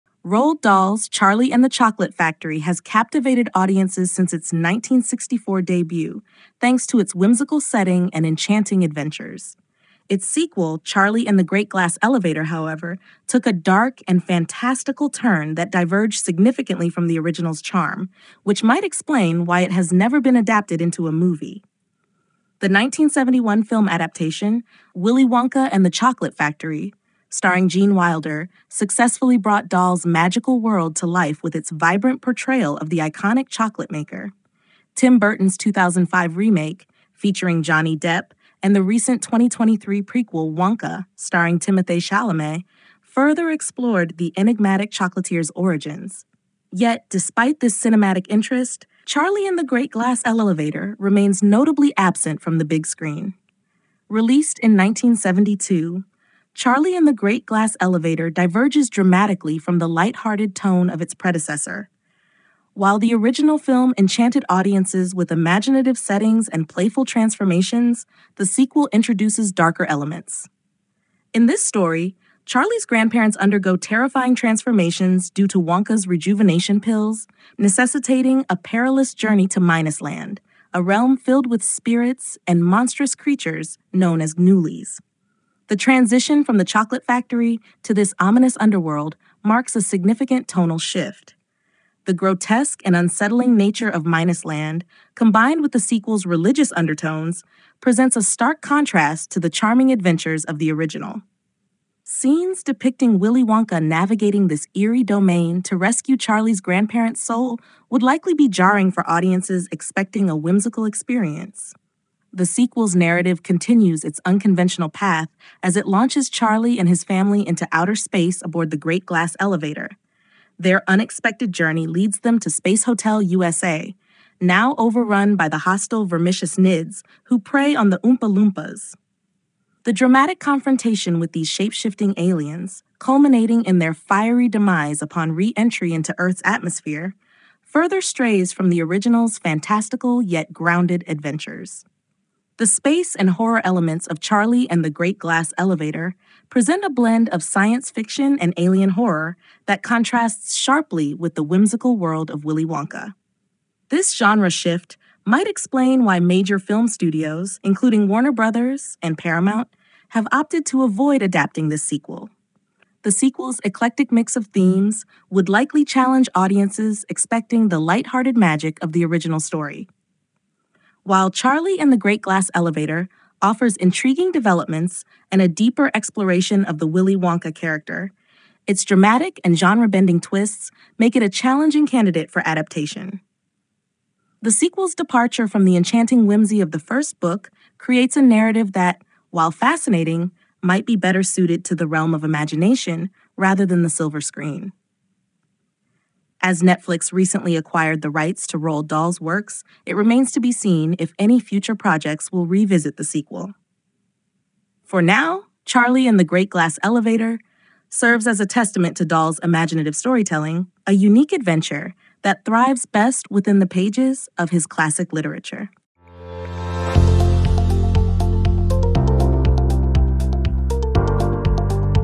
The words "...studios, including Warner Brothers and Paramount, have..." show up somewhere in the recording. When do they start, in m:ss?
2:36.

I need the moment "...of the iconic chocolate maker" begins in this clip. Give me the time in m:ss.
0:32.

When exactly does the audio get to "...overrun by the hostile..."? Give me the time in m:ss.
2:04.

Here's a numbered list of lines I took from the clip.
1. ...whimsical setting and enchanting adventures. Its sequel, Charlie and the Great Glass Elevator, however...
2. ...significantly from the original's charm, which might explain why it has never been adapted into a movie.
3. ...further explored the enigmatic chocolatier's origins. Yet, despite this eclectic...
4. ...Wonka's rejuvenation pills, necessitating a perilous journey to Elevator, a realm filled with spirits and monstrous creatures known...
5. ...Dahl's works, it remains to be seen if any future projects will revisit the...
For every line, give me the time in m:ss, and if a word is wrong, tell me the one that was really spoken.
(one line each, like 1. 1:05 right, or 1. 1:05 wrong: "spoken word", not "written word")
1. 0:07 right
2. 0:16 right
3. 0:43 wrong: "cinematic", not "eclectic"
4. 1:15 wrong: "Minusland", not "Elevator"
5. 3:18 right.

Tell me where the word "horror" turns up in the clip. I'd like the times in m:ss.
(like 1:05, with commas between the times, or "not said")
2:23, 2:28.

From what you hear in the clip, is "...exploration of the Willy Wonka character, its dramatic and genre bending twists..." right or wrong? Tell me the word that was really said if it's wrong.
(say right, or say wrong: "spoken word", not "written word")
right.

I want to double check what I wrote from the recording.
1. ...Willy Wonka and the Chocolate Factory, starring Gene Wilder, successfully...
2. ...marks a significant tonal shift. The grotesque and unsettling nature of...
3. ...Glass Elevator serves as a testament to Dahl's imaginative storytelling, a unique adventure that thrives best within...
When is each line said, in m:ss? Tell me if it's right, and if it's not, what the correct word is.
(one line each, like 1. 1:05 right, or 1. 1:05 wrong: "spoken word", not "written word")
1. 0:24 right
2. 1:29 right
3. 3:26 right.